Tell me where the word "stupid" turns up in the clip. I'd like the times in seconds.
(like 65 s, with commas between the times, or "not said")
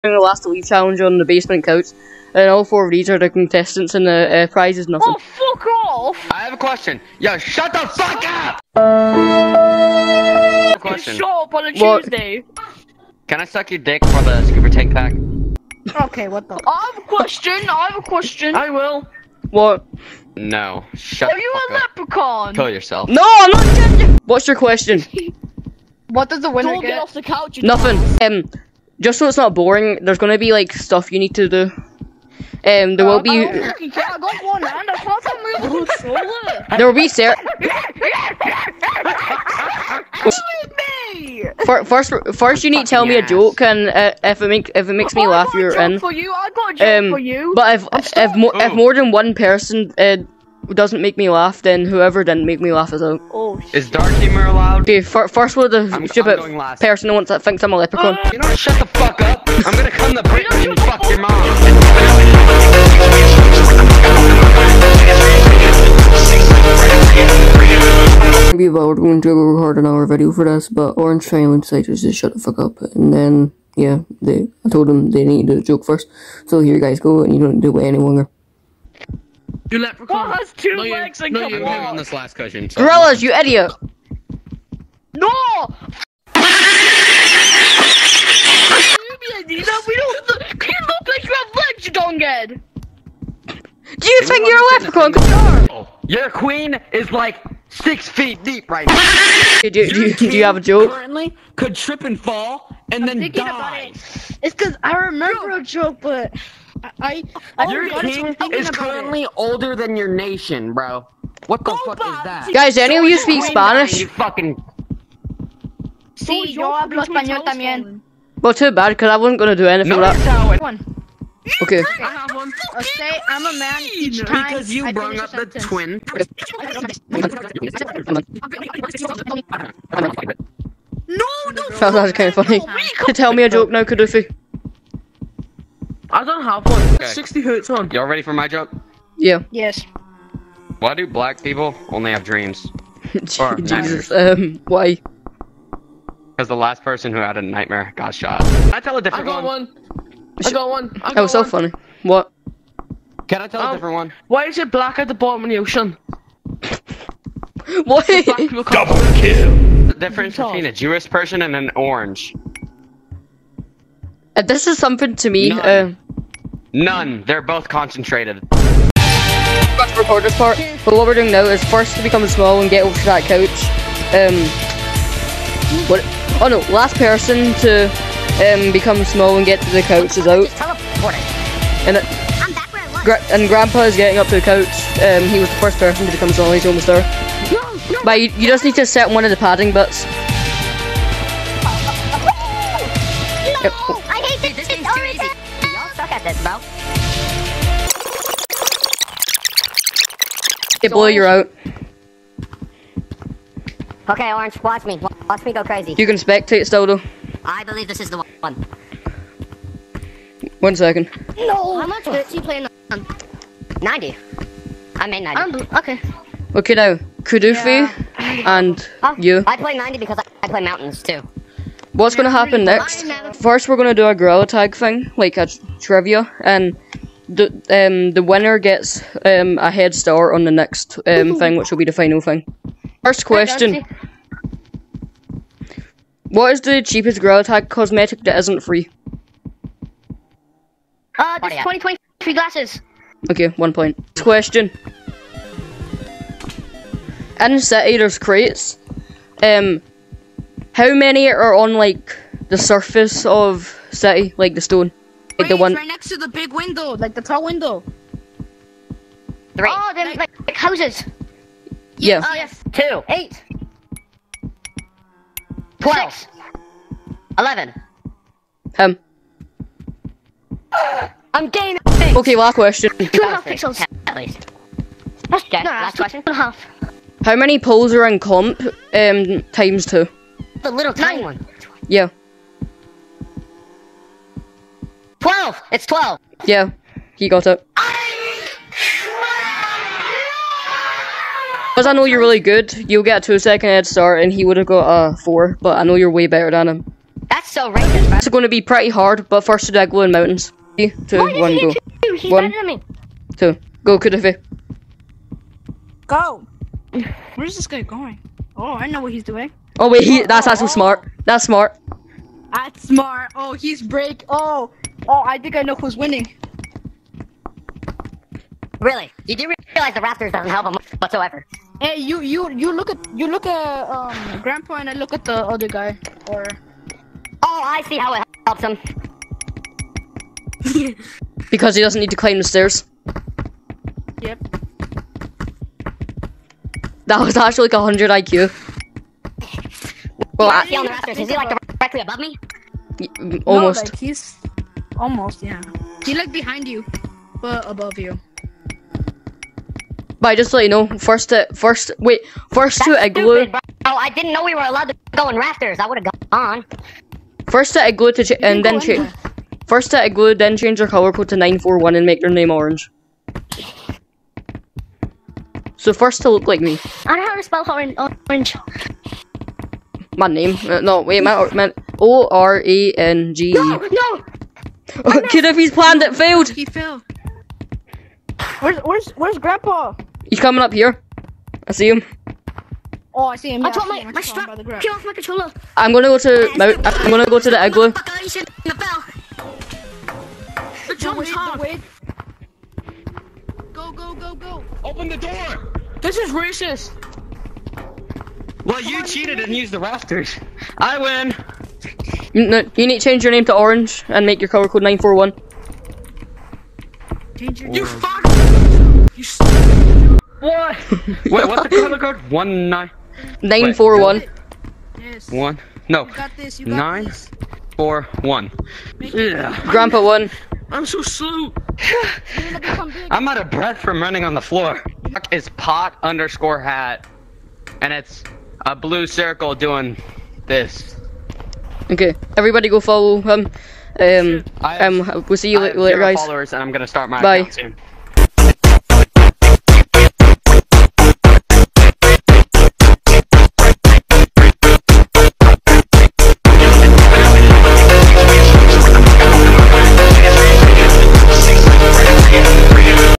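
56 s, 353 s.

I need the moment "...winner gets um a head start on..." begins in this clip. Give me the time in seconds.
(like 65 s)
228 s.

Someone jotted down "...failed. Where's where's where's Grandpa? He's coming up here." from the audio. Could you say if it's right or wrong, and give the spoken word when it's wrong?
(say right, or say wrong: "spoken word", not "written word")
right.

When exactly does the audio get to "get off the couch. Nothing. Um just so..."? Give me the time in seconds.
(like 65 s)
26 s.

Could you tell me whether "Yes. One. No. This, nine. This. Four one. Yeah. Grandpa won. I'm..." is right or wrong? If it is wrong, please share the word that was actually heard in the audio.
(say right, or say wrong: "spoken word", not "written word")
right.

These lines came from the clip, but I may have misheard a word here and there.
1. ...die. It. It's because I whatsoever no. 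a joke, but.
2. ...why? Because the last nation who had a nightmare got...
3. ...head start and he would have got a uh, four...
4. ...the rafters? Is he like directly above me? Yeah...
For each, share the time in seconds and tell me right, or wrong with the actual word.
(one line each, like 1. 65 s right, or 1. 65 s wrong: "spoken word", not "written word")
1. 103 s wrong: "remember", not "whatsoever"
2. 144 s wrong: "person", not "nation"
3. 293 s right
4. 340 s right.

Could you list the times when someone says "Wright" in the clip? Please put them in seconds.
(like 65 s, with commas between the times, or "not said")
not said.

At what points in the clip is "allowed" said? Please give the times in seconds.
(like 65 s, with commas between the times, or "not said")
54 s, 354 s.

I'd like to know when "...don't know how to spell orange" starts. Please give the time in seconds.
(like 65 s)
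367 s.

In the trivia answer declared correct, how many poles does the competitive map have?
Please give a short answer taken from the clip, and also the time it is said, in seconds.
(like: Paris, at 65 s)
12, at 285 s.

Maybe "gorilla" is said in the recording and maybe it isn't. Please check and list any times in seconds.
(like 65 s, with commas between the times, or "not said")
82 s, 224 s, 237 s.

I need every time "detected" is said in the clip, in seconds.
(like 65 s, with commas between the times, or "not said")
not said.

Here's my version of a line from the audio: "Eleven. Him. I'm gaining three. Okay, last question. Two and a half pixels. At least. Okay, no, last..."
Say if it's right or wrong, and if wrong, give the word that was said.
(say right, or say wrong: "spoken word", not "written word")
wrong: "six", not "three".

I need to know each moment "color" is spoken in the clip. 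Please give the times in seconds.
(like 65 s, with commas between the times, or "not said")
360 s, 404 s, 411 s.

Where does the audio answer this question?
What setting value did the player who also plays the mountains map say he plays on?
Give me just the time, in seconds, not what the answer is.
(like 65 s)
219 s.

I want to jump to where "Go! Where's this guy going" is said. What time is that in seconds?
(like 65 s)
306 s.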